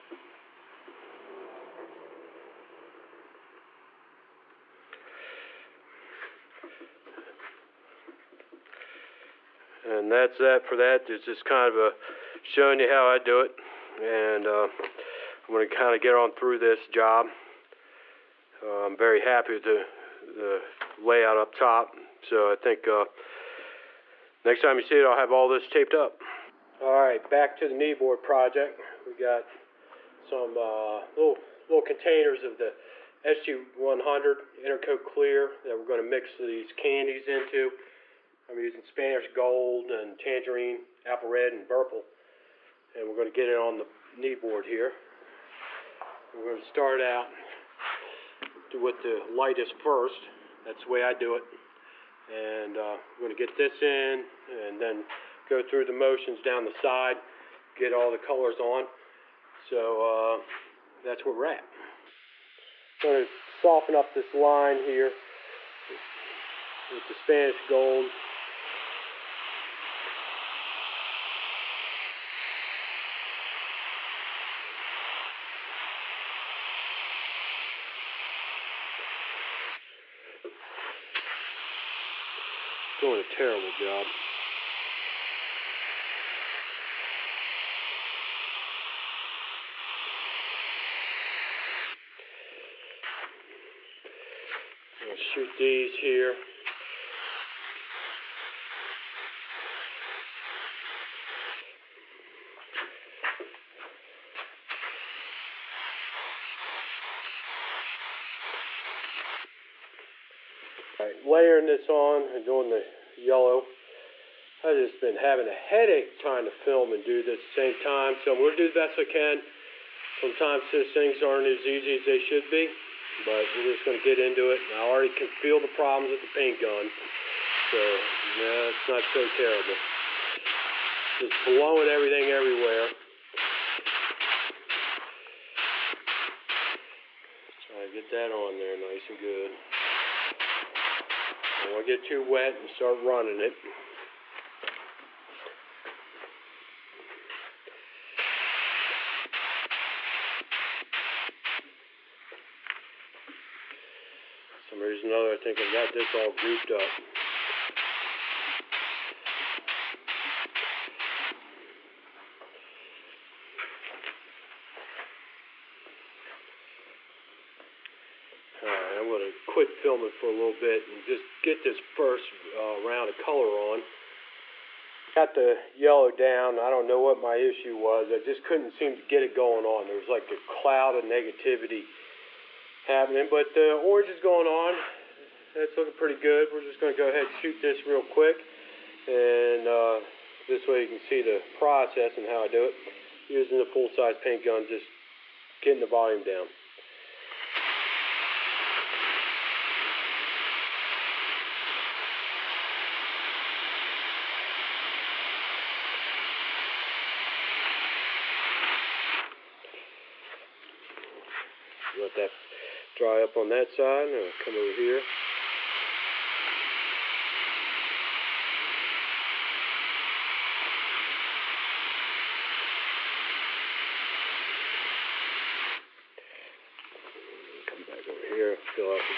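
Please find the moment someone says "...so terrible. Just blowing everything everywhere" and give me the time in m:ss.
2:09.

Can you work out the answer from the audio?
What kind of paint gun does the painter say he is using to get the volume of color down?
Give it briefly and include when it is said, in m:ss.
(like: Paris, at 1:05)
full-size paint gun, at 3:13.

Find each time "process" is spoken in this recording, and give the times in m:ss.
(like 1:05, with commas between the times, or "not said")
3:11.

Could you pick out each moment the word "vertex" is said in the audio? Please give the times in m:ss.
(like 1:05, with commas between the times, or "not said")
not said.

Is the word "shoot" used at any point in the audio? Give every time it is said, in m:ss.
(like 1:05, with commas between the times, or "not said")
1:35, 3:07.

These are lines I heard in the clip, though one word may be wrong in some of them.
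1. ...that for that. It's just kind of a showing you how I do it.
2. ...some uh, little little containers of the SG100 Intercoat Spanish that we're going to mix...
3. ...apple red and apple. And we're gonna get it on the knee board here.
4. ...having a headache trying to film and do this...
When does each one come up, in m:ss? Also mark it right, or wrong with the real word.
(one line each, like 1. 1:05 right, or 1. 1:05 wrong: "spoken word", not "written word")
1. 0:10 right
2. 0:30 wrong: "Clear", not "Spanish"
3. 0:41 wrong: "purple", not "apple"
4. 1:55 right.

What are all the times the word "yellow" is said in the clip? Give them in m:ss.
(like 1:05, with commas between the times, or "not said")
1:53, 2:55.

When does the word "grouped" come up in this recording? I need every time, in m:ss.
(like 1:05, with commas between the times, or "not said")
2:36.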